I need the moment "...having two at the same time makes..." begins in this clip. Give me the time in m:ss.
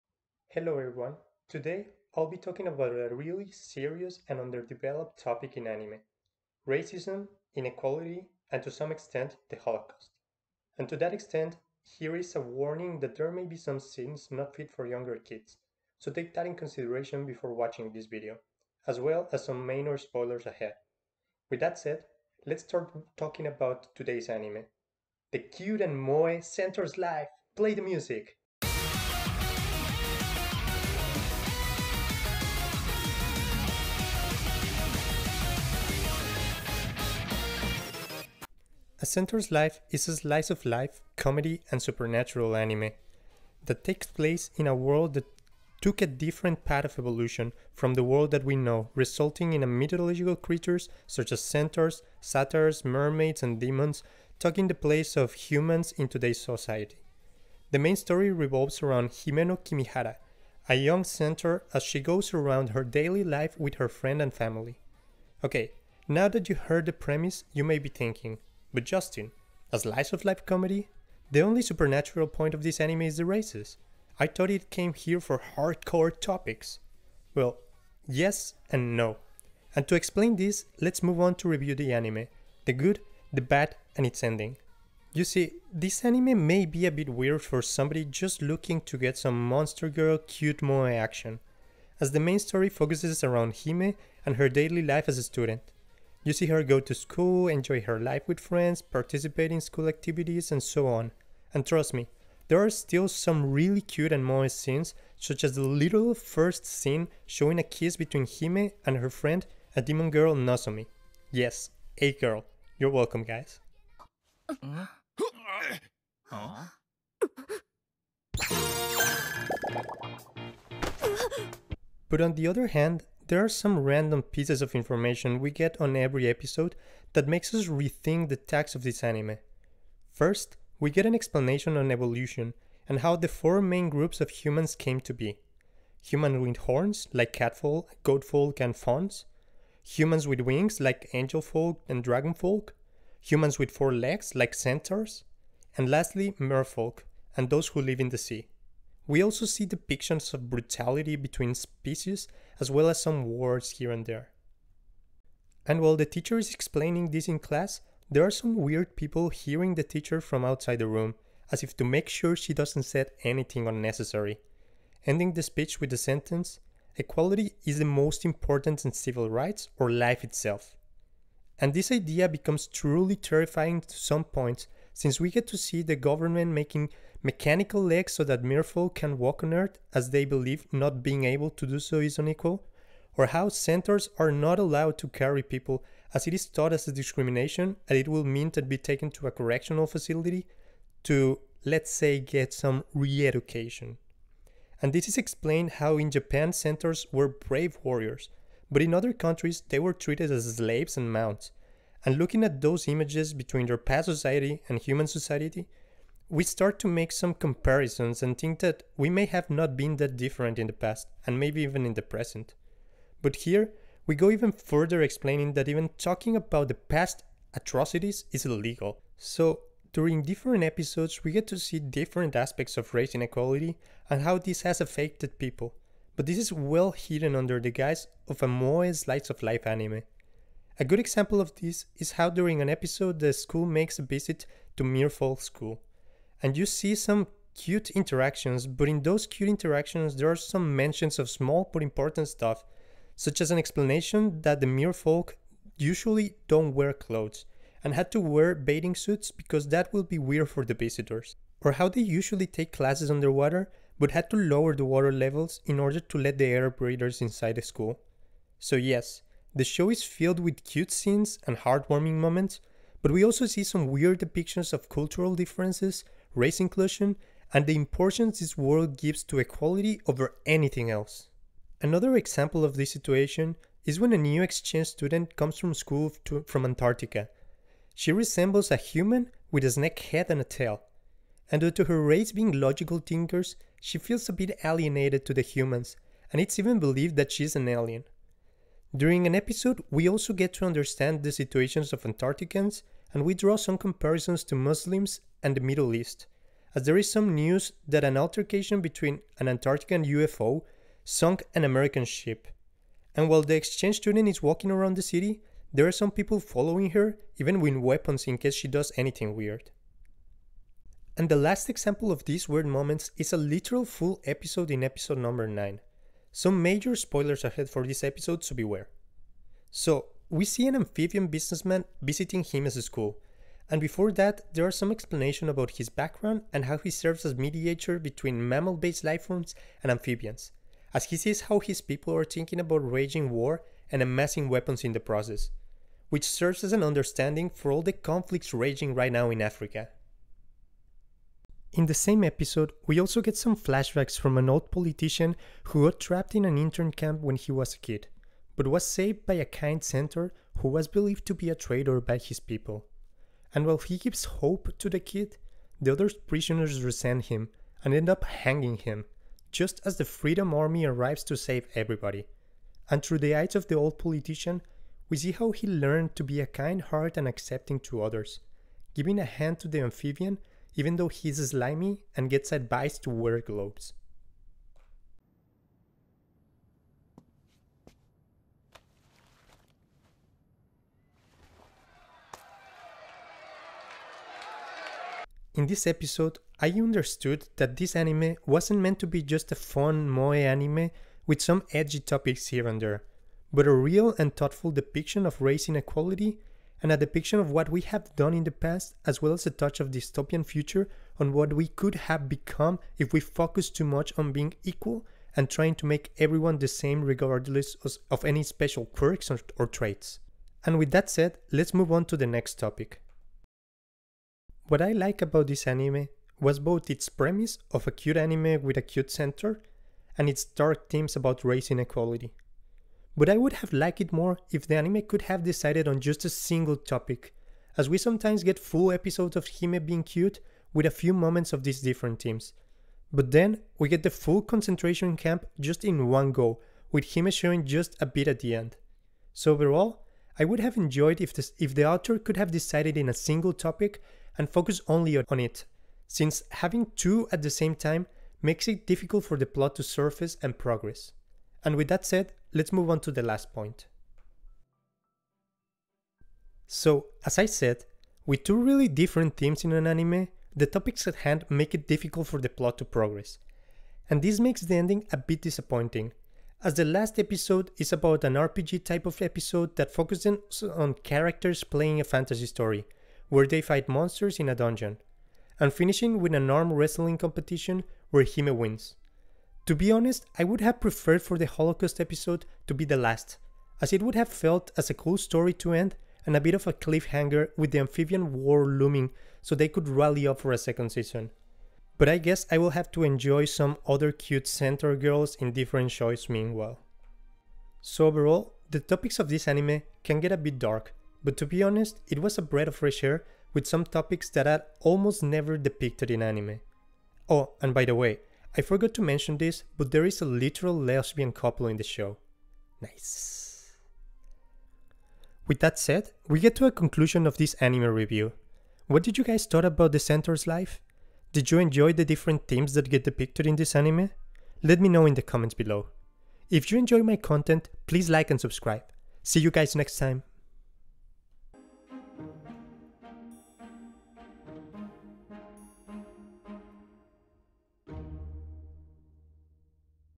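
7:26.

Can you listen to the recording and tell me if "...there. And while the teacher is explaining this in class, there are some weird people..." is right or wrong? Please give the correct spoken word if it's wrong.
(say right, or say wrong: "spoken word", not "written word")
right.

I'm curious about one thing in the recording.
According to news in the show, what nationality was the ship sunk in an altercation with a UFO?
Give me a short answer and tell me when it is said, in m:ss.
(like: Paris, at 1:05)
American, at 5:01.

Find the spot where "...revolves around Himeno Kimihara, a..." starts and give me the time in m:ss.
0:58.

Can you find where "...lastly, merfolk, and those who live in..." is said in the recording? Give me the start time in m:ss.
2:25.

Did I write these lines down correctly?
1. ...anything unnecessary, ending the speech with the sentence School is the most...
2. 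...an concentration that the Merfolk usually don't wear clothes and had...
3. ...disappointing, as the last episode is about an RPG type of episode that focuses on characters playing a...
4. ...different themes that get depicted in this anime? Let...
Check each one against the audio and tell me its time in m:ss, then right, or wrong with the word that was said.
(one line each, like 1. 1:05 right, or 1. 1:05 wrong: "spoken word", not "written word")
1. 2:43 wrong: "Equality", not "School"
2. 4:03 wrong: "explanation", not "concentration"
3. 7:45 right
4. 8:42 right.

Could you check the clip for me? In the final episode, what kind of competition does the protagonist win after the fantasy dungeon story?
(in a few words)
Arm wrestling.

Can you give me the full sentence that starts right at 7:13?
But then we get the full concentration camp just in one go, with Hime showing just a bit at the end.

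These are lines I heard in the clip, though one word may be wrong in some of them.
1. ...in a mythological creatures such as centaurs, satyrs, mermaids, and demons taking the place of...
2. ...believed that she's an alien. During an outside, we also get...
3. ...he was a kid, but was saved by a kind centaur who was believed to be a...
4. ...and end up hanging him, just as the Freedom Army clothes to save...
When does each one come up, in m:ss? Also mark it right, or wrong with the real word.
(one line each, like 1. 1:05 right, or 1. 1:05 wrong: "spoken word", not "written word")
1. 0:49 right
2. 4:46 wrong: "episode", not "outside"
3. 5:47 right
4. 5:57 wrong: "arrives", not "clothes".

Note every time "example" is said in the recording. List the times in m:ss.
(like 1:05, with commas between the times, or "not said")
3:50, 4:32, 5:11.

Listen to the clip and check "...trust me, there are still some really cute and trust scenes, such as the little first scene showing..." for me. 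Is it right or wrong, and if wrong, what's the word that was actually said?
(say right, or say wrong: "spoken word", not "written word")
wrong: "moist", not "trust".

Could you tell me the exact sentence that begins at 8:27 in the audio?
Oh, and by the way, I forgot to mention this, but there is a literal lesbian couple in the show.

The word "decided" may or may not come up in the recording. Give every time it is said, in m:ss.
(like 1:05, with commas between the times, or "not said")
7:05, 7:22.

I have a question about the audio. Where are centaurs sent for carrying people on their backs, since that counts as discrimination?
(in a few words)
Correctional facility.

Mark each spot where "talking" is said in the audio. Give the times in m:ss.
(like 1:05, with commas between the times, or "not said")
0:02, 0:23, 3:35.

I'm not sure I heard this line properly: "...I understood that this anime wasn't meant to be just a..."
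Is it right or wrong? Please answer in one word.
right.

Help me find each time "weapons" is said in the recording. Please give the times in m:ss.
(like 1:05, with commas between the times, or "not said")
5:07, 5:34.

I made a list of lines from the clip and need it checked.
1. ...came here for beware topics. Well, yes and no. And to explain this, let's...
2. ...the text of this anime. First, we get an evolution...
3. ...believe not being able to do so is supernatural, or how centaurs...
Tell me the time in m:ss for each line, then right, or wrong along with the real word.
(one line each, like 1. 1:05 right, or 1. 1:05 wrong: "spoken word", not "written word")
1. 1:14 wrong: "hardcore", not "beware"
2. 2:08 wrong: "explanation", not "evolution"
3. 3:00 wrong: "unequal", not "supernatural".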